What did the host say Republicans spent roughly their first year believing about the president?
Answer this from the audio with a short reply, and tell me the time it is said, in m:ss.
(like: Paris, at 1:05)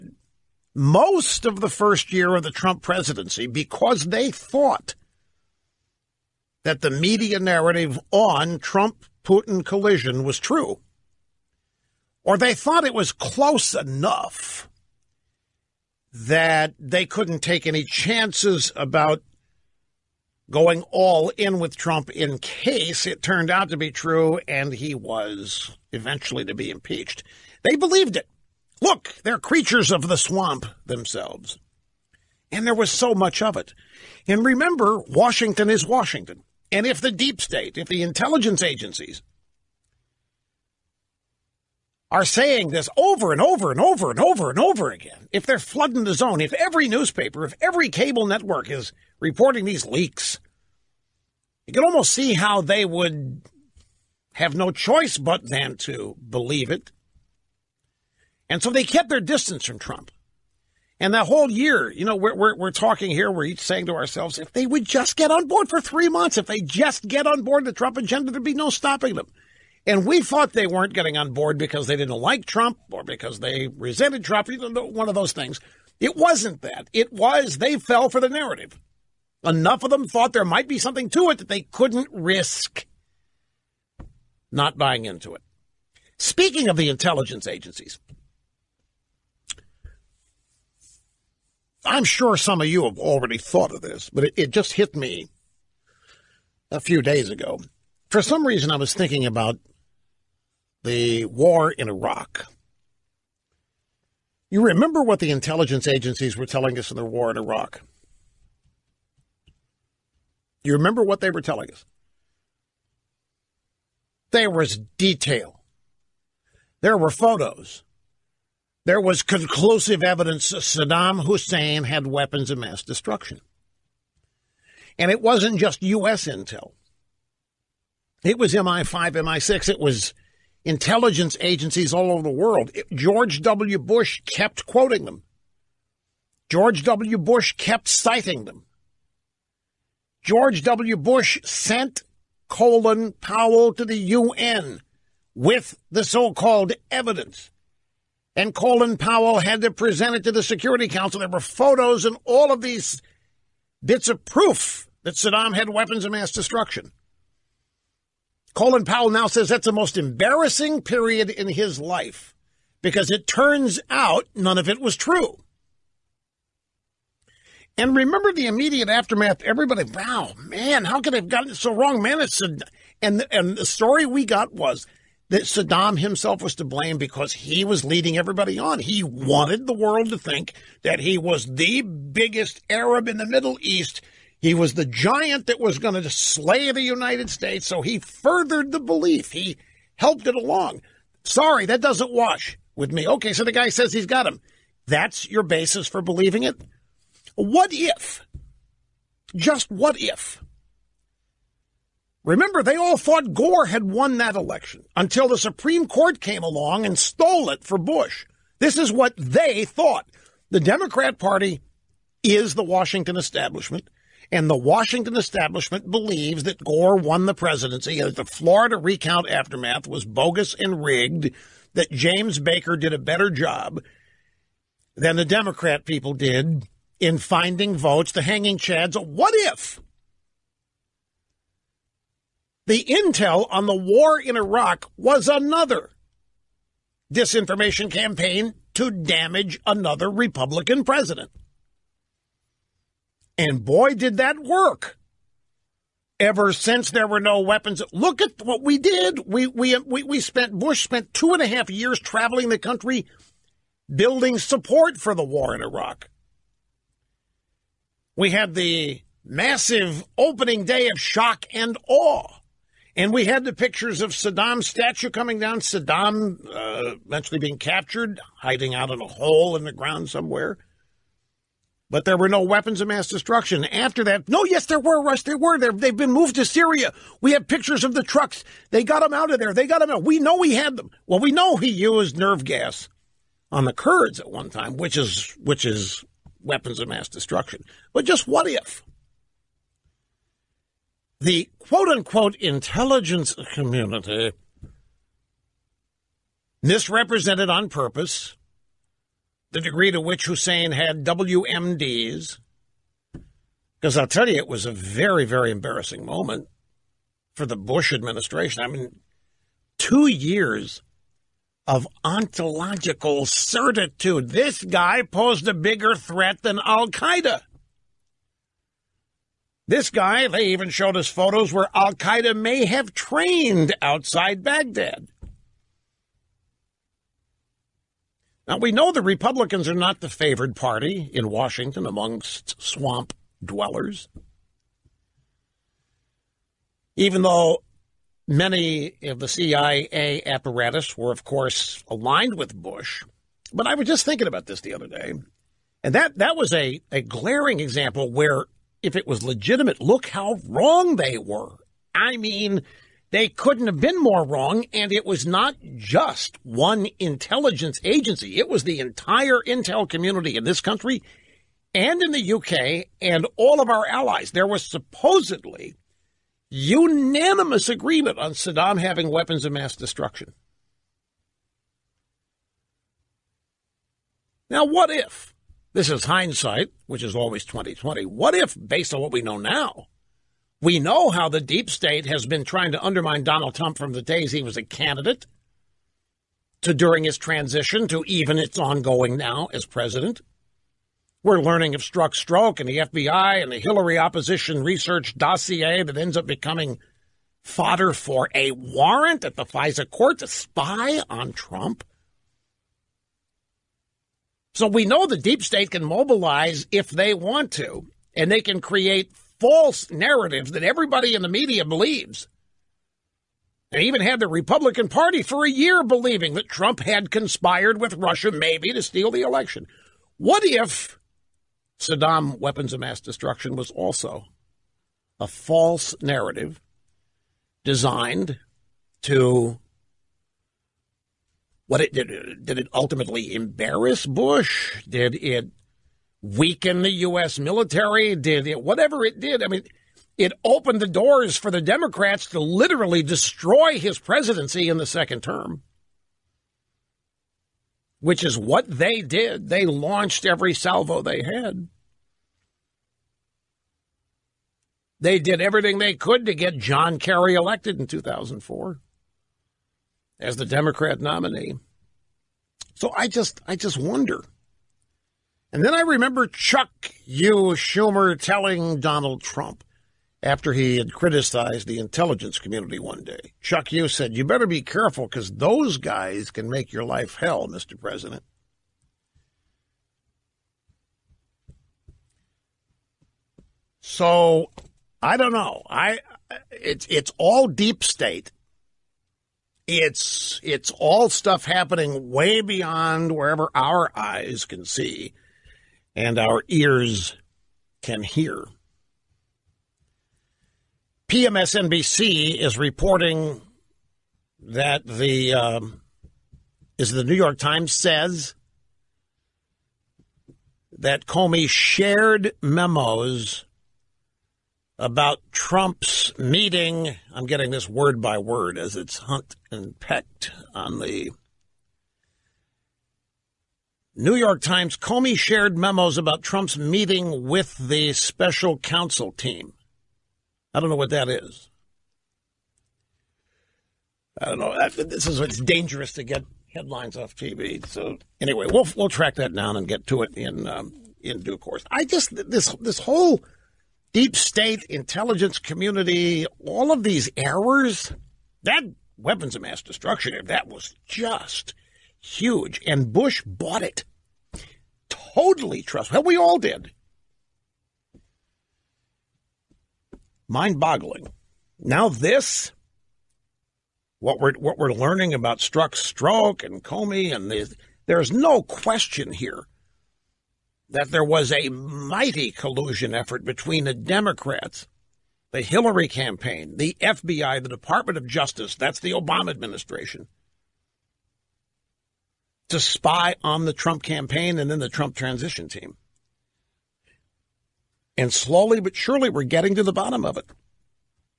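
Trump Putin collision, at 0:08.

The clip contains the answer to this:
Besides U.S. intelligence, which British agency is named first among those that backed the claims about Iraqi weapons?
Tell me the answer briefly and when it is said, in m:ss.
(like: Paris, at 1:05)
MI5, at 2:08.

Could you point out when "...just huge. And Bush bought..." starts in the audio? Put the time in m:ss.
9:10.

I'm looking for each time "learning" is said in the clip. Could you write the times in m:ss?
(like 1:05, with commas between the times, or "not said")
6:31, 9:24.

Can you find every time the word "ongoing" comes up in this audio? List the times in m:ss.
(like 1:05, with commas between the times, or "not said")
6:28.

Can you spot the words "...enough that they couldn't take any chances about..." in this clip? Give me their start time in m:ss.
0:13.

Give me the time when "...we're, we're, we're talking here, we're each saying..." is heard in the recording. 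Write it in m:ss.
1:02.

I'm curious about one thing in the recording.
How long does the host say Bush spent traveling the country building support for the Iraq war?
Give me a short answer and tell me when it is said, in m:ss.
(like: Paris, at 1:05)
2.5 years, at 4:11.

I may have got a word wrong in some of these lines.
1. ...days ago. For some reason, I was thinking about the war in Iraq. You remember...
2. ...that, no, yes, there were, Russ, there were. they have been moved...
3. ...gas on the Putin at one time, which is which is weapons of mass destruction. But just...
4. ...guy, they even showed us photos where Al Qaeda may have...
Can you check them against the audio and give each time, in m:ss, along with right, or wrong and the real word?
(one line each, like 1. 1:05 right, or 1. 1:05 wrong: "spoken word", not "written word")
1. 1:37 right
2. 4:34 right
3. 4:42 wrong: "Kurds", not "Putin"
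4. 5:19 right.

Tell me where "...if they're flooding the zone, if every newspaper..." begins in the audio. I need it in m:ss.
0:45.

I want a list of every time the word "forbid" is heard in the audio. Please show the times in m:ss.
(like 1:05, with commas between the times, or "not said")
not said.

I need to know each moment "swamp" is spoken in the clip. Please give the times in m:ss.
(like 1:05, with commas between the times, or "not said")
0:30, 5:32.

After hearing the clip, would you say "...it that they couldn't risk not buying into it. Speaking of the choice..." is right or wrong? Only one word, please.
wrong.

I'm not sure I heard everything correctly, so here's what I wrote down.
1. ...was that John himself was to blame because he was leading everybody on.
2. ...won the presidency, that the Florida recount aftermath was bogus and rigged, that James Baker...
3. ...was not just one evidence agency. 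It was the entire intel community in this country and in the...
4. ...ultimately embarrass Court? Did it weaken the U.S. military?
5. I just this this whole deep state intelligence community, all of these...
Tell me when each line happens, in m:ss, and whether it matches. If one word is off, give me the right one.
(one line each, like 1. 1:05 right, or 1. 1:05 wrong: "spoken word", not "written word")
1. 2:54 wrong: "Saddam", not "John"
2. 3:36 right
3. 5:55 wrong: "intelligence", not "evidence"
4. 7:12 wrong: "Bush", not "Court"
5. 9:01 right.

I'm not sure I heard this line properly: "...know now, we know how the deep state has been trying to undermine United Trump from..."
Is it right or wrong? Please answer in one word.
wrong.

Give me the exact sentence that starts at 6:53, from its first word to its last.
They even had the Republican Party for a year believing that Trump had conspired with Russia, maybe, to steal the election.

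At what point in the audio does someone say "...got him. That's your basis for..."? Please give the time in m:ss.
3:14.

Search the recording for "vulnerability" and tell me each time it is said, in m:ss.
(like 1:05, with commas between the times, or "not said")
not said.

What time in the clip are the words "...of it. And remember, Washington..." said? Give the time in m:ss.
0:33.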